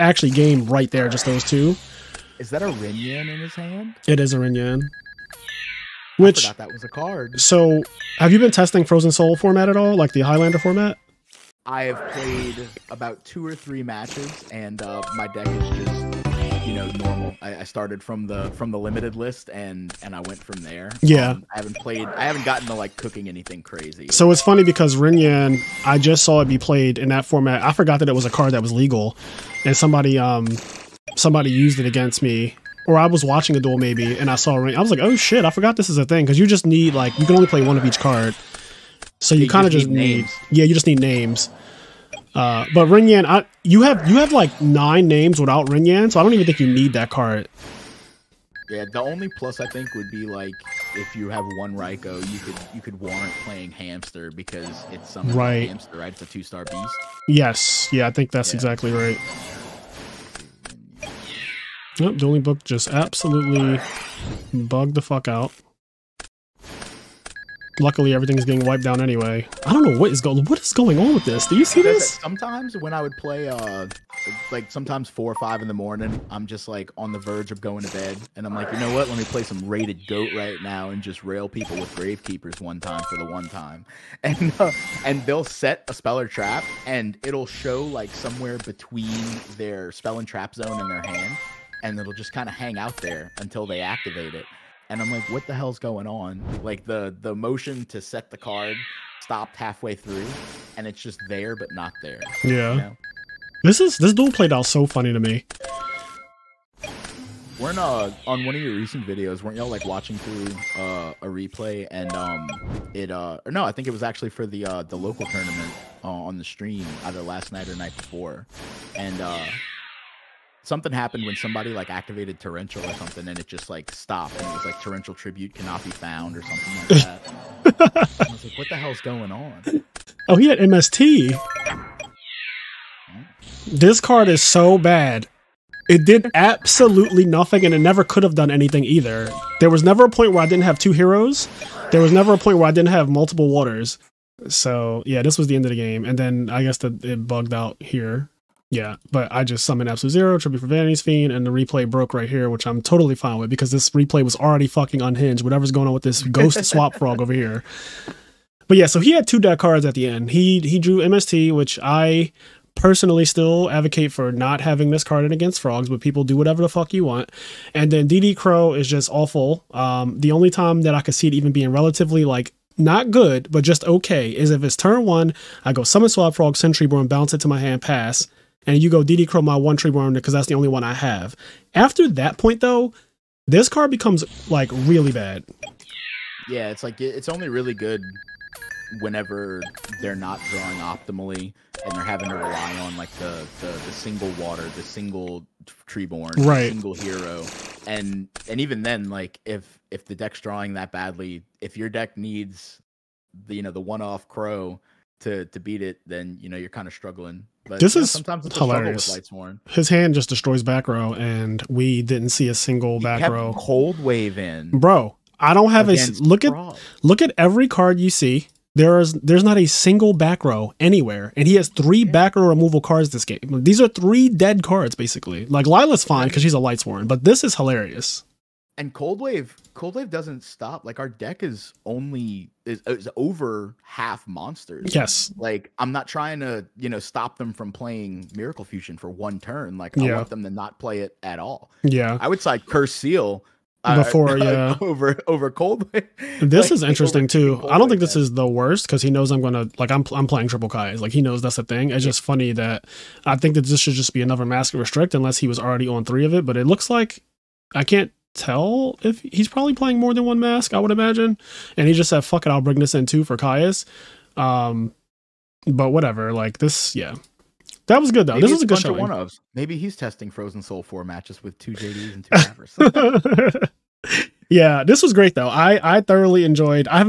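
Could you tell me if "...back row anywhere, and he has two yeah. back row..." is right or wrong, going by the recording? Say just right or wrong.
wrong.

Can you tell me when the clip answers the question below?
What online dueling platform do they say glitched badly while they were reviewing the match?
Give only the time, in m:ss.
1:02.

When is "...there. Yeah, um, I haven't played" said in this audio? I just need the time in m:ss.
0:20.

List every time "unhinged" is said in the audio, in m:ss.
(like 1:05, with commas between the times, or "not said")
2:35.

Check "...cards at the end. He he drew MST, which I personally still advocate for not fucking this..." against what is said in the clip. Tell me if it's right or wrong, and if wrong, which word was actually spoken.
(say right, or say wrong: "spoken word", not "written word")
wrong: "having", not "fucking".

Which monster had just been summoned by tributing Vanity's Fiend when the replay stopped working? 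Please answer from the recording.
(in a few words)
Absolute Zero.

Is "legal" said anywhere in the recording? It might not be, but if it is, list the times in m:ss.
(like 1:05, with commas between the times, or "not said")
0:28.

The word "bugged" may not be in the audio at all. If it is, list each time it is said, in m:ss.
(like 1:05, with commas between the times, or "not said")
1:04, 2:27.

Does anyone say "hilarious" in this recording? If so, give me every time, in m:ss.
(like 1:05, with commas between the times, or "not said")
3:28, 3:47.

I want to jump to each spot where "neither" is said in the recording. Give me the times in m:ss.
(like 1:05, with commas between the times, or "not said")
not said.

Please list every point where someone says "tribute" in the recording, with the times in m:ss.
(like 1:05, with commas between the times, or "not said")
2:05, 2:30.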